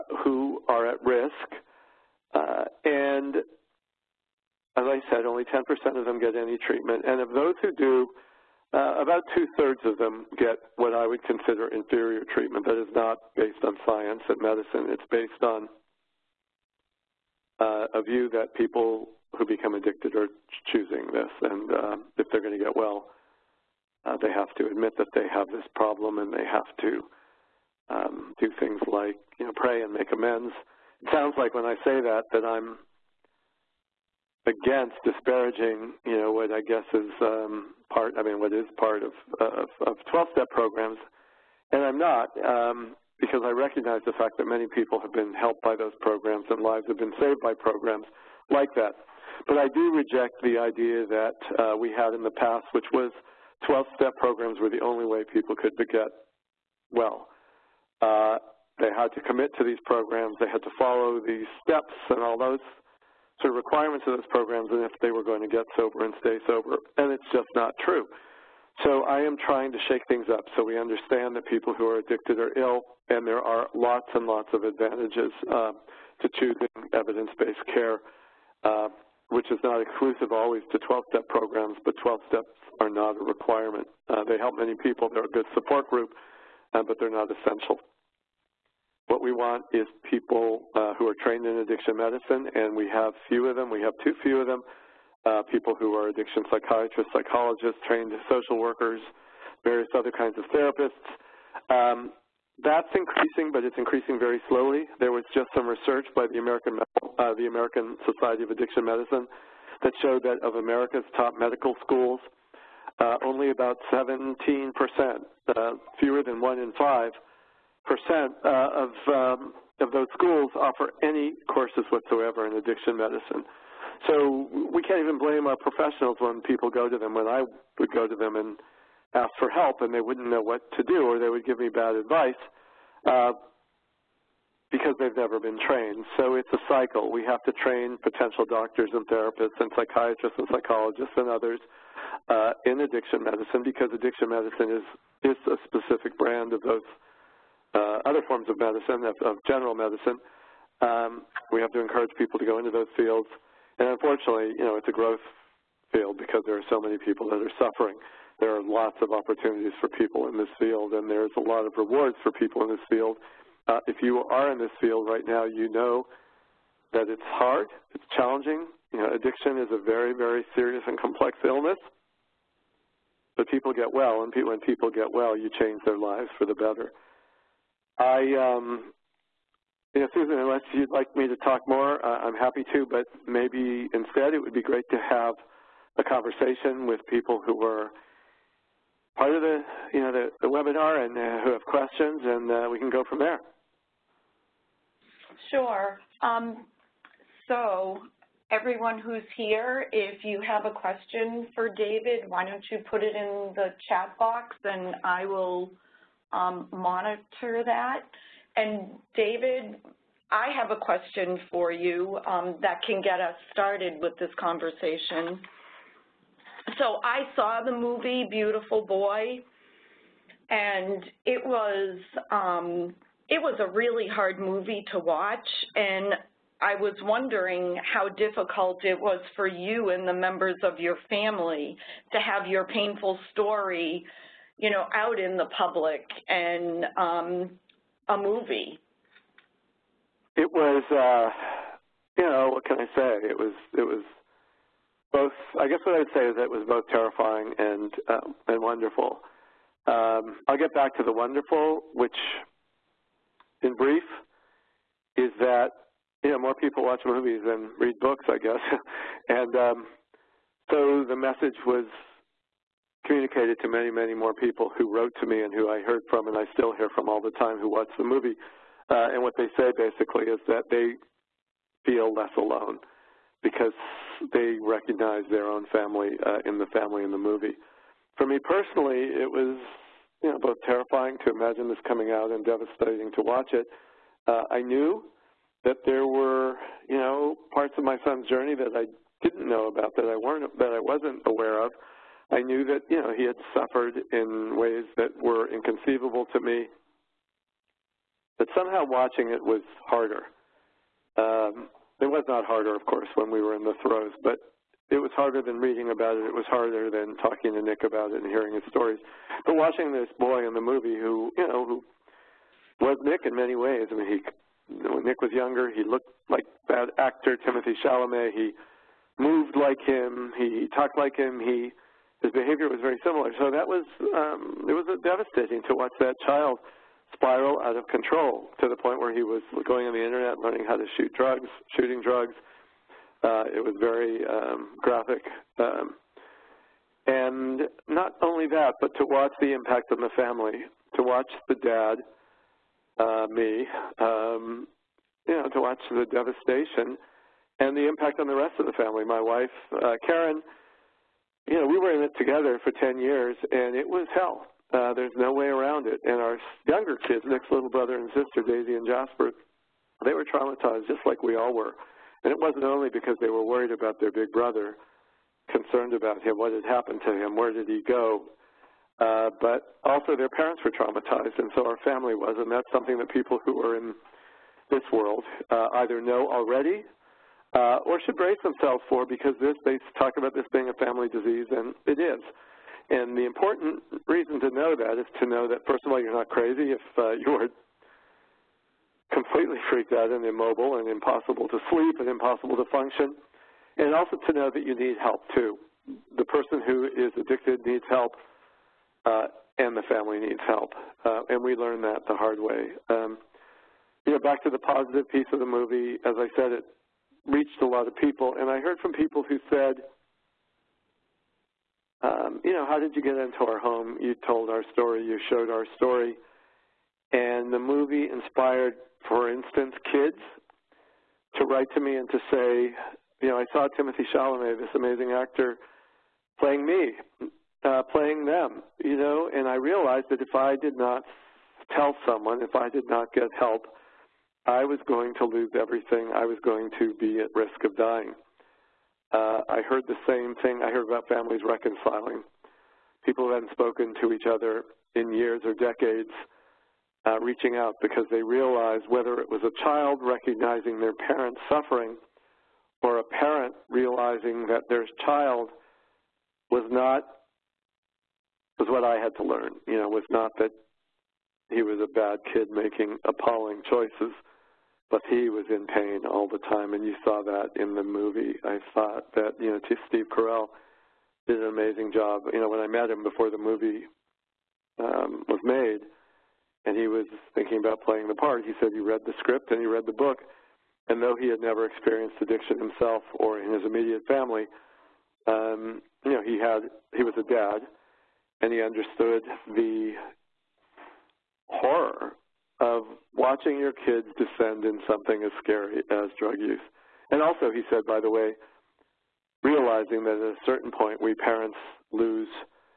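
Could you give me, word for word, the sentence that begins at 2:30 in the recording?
Um, we have to encourage people to go into those fields.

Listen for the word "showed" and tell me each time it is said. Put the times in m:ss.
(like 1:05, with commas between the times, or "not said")
1:50, 6:55.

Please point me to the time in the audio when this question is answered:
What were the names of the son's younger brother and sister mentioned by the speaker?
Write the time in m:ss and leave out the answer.
5:58.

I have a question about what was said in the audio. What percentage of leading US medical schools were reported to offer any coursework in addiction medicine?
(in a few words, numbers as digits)
17%.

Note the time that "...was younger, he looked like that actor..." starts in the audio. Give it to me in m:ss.
5:15.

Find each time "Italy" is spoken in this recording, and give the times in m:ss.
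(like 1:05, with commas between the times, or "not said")
not said.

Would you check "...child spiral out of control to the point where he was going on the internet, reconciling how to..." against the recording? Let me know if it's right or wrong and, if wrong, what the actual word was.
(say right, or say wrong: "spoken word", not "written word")
wrong: "learning", not "reconciling".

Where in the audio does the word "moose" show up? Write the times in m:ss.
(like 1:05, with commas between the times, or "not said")
not said.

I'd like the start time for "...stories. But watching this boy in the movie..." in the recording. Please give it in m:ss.
5:08.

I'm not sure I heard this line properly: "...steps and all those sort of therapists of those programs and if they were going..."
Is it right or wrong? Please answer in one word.
wrong.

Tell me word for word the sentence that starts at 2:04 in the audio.
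So we can't even blame our professionals when people go to them.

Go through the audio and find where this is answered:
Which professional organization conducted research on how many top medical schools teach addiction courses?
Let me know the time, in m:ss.
1:47.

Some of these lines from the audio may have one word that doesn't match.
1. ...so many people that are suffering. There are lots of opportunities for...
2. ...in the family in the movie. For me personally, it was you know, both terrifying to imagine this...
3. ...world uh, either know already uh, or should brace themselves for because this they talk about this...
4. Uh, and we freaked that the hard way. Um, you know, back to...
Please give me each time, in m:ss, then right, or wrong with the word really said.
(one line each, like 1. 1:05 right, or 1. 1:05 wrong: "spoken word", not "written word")
1. 2:36 right
2. 4:36 right
3. 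6:14 right
4. 6:41 wrong: "learned", not "freaked".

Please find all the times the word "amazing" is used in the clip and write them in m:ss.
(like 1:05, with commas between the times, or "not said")
7:04, 7:51.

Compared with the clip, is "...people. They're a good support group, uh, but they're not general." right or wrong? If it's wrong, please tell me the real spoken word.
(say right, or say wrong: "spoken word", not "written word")
wrong: "essential", not "general".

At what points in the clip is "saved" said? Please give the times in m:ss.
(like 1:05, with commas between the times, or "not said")
0:47.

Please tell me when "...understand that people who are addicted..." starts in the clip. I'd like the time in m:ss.
1:10.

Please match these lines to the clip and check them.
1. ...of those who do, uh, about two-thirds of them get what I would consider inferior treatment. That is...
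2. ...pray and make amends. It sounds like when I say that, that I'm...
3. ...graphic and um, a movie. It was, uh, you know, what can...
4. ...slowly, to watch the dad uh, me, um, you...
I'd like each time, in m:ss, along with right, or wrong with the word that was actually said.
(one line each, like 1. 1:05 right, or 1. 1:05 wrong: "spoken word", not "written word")
1. 0:07 right
2. 0:29 right
3. 3:55 wrong: "public", not "graphic"
4. 5:40 wrong: "family", not "slowly".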